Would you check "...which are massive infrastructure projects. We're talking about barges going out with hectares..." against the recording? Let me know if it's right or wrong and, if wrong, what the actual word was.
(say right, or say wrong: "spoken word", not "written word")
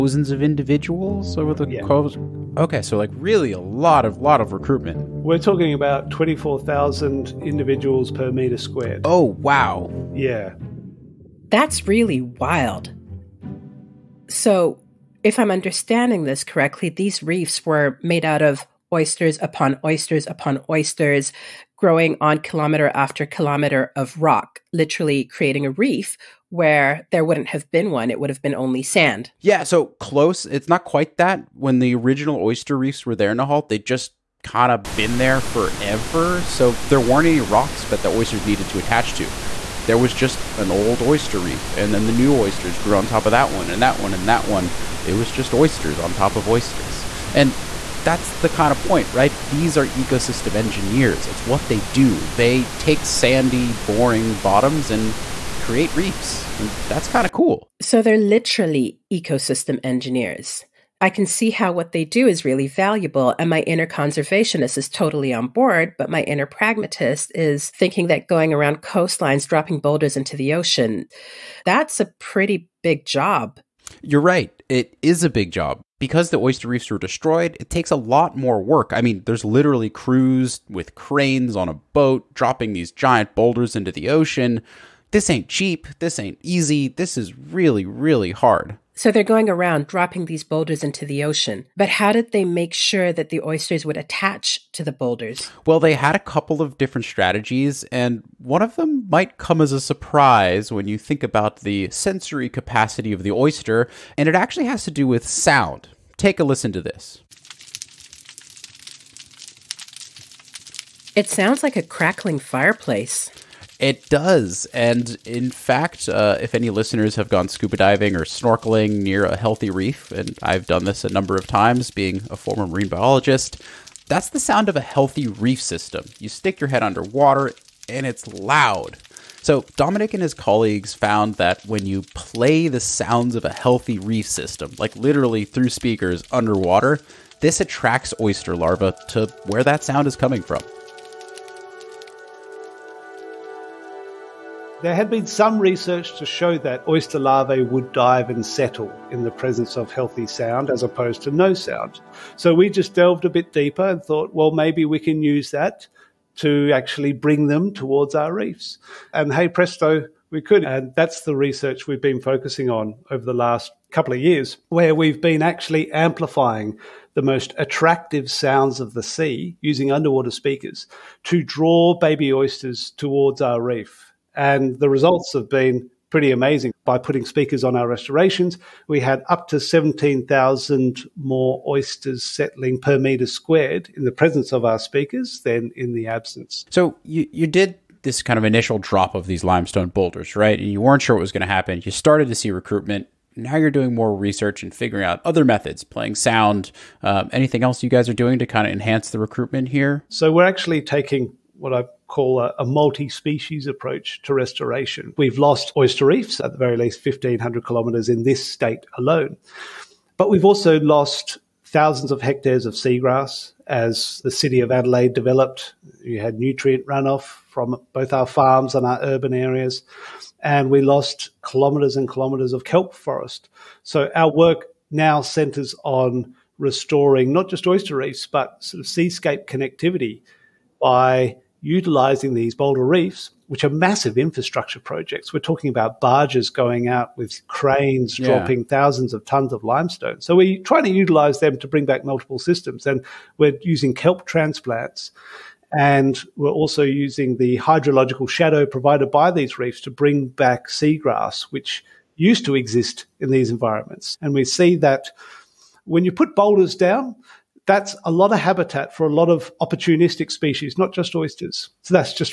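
wrong: "cranes", not "hectares".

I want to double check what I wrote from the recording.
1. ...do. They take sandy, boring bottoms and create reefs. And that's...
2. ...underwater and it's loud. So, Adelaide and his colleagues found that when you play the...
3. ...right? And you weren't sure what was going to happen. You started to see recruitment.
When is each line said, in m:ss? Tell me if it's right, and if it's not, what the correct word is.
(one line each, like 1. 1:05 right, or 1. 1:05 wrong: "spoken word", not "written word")
1. 0:51 right
2. 2:06 wrong: "Dominic", not "Adelaide"
3. 3:10 right.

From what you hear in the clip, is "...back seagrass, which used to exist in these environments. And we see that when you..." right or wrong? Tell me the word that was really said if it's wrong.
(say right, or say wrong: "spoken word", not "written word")
right.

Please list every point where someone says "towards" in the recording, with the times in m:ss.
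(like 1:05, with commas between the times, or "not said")
2:37, 2:52.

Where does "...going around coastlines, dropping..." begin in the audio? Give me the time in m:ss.
1:08.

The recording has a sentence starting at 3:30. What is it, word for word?
But we've also lost thousands of hectares of seagrass as the city of Adelaide developed.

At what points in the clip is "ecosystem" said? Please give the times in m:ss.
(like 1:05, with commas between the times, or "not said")
0:49, 0:59.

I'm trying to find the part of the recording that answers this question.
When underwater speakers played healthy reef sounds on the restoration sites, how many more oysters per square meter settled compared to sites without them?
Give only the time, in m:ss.
2:59.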